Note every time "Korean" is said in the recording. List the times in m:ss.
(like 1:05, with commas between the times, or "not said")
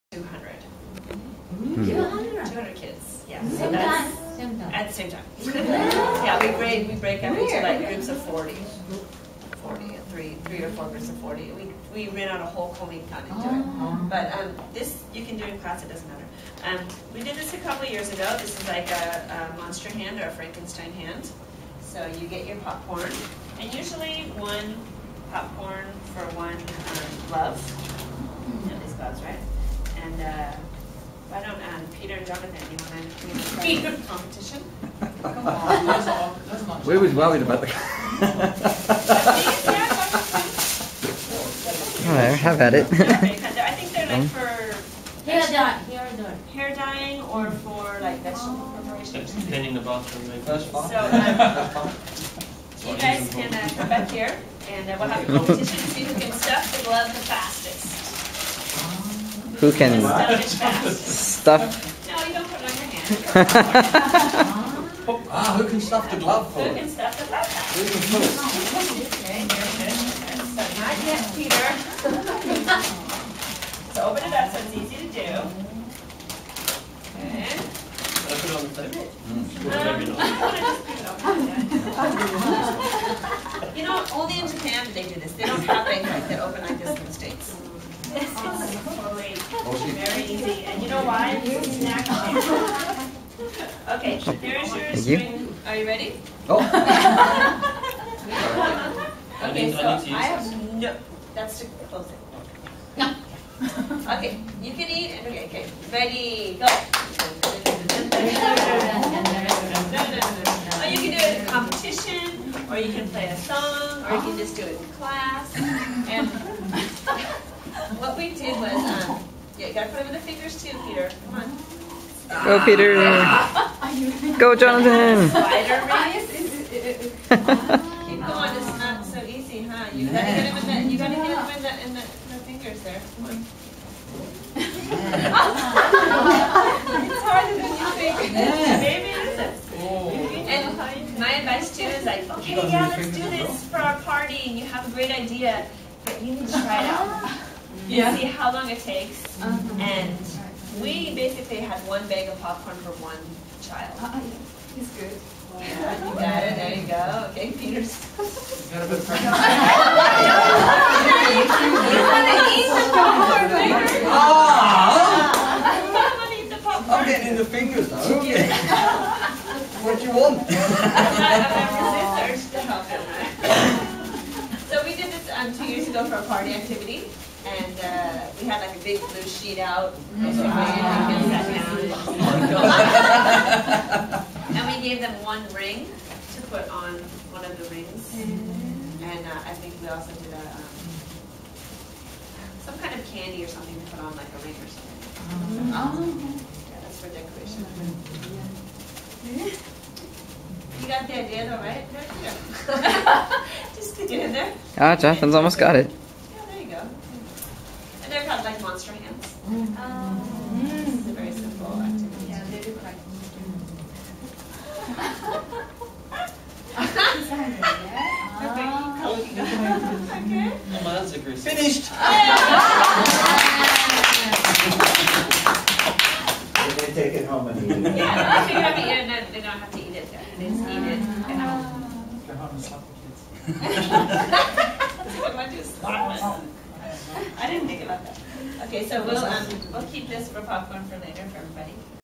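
0:12.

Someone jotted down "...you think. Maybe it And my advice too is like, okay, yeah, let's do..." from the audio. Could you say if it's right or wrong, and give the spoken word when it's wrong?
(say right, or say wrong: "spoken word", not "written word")
right.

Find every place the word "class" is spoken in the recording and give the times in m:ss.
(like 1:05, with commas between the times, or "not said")
0:15, 1:54.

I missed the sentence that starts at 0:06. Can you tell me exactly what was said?
yeah, we break, we break up into like groups of 40.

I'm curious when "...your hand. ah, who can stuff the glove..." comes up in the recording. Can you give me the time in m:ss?
1:02.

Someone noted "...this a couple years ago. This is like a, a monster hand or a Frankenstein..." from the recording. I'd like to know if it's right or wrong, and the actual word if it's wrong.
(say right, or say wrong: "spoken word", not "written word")
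right.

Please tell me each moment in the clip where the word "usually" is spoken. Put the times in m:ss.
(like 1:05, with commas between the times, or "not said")
0:23.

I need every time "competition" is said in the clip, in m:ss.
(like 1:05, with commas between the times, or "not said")
0:34, 0:55, 1:51.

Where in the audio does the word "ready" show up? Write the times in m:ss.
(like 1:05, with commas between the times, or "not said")
1:35, 1:45.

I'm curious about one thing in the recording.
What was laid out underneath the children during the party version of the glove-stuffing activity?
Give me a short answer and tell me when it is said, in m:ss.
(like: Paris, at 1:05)
a big blue sheet, at 2:58.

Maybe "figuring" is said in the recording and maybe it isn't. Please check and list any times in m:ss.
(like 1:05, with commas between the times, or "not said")
not said.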